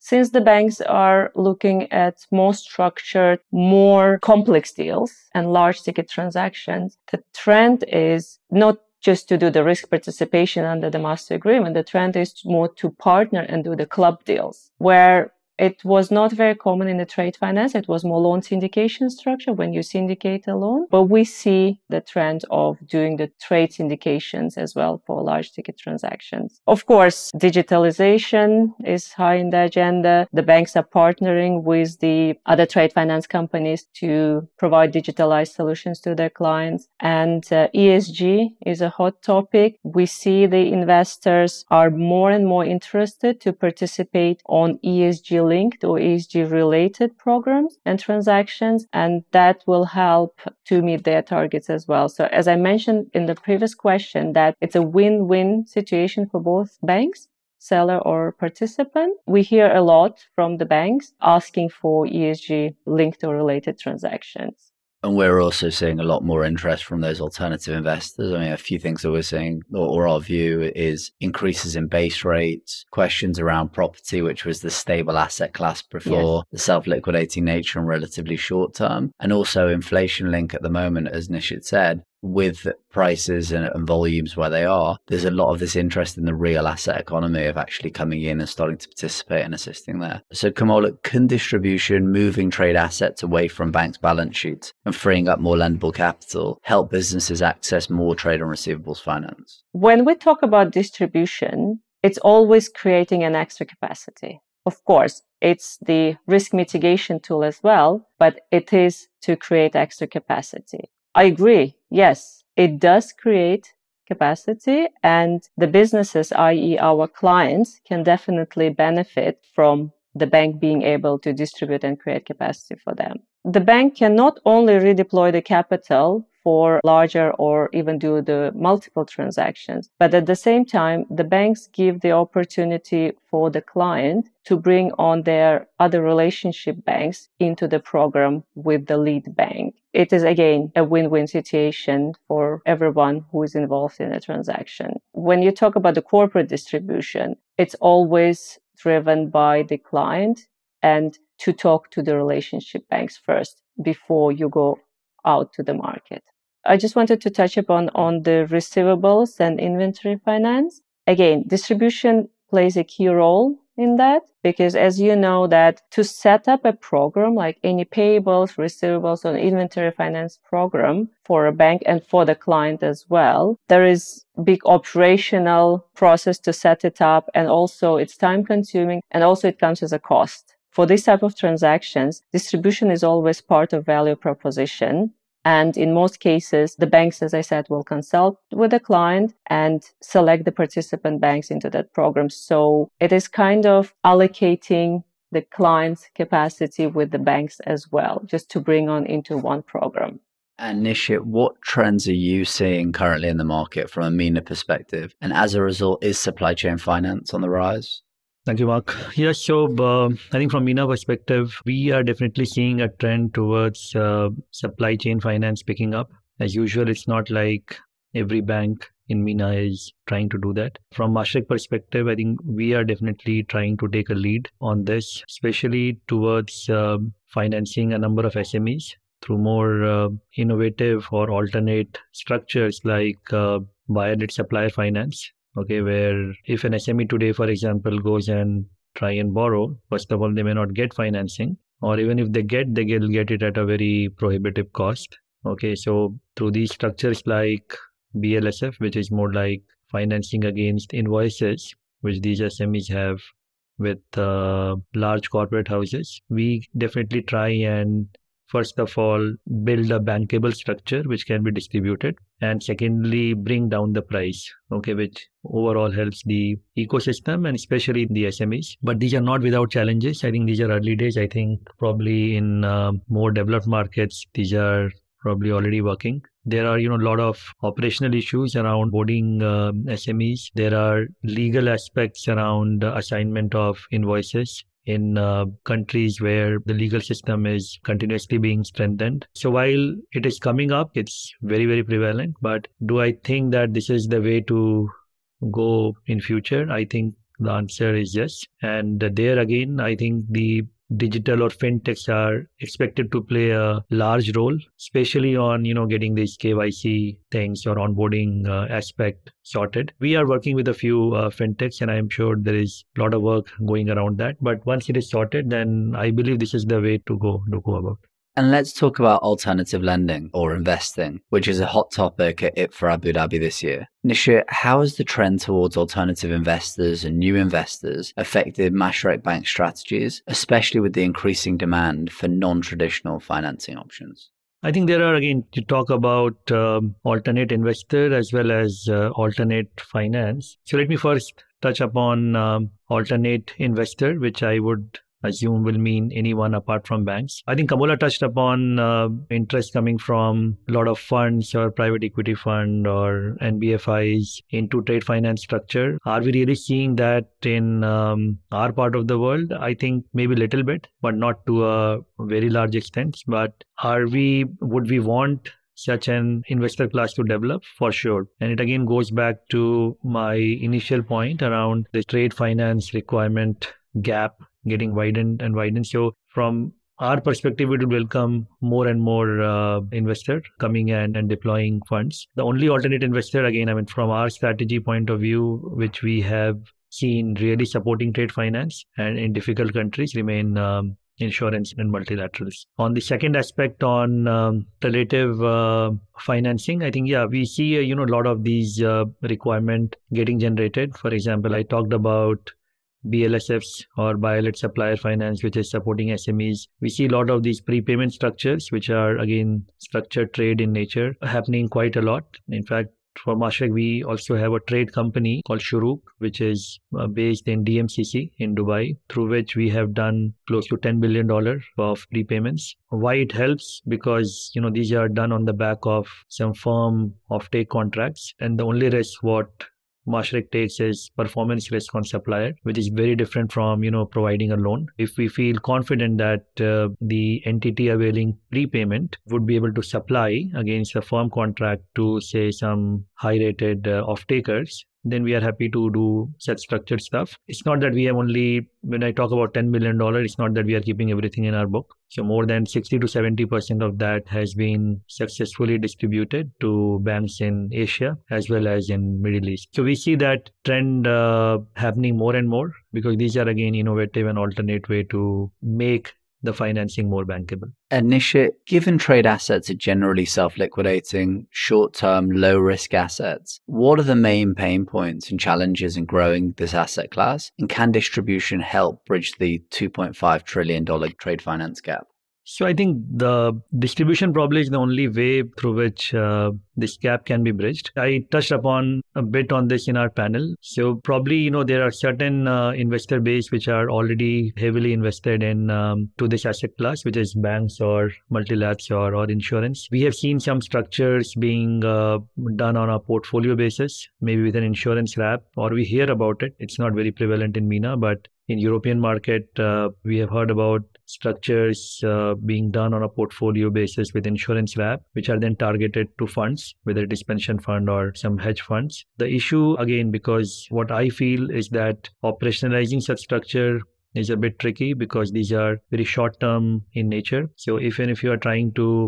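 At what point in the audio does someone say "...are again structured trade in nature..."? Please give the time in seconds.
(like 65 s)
408 s.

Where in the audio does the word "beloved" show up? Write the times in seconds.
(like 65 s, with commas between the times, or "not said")
not said.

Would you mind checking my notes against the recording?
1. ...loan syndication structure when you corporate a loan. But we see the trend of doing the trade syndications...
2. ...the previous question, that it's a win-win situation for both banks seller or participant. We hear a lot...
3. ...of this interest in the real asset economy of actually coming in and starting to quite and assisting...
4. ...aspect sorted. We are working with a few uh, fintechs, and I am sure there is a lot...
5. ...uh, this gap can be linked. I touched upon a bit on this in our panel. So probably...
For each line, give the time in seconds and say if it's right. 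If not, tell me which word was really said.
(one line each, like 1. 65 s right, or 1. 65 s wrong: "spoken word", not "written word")
1. 18 s wrong: "syndicate", not "corporate"
2. 53 s right
3. 85 s wrong: "participate", not "quite"
4. 308 s right
5. 486 s wrong: "bridged", not "linked".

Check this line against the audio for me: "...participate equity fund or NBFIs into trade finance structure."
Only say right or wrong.
wrong.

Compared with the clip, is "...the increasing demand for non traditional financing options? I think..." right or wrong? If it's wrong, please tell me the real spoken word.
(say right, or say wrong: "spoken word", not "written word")
right.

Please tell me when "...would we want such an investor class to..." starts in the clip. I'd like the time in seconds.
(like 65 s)
364 s.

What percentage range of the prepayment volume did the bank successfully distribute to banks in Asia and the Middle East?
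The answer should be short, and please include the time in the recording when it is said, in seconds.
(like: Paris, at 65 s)
60 to 70%, at 452 s.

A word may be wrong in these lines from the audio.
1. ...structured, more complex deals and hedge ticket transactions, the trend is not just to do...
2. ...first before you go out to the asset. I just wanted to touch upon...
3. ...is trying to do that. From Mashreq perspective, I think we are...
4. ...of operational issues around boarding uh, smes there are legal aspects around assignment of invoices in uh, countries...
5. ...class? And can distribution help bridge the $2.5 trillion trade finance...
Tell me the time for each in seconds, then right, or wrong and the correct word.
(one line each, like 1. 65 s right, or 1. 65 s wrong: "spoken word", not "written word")
1. 2 s wrong: "large", not "hedge"
2. 153 s wrong: "market", not "asset"
3. 219 s right
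4. 277 s right
5. 477 s right.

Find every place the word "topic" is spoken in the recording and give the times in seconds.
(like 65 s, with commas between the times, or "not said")
39 s, 321 s.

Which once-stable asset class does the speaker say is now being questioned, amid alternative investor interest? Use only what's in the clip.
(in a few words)
property.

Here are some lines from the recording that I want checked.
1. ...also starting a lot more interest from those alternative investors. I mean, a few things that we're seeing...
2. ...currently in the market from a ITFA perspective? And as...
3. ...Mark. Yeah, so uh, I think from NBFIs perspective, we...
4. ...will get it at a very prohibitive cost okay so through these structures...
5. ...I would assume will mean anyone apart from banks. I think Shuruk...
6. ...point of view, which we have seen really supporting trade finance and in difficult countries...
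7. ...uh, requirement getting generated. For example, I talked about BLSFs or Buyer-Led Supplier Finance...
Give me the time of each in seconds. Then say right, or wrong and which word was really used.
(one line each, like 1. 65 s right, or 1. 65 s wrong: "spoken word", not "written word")
1. 65 s wrong: "seeing", not "starting"
2. 202 s wrong: "MENA", not "ITFA"
3. 208 s wrong: "MENA", not "NBFIs"
4. 242 s right
5. 344 s wrong: "Kamola", not "Shuruk"
6. 384 s right
7. 398 s right.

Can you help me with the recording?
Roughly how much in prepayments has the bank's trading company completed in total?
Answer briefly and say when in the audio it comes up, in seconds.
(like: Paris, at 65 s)
$10 billion, at 420 s.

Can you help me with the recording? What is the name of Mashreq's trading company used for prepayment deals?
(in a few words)
Shuruk.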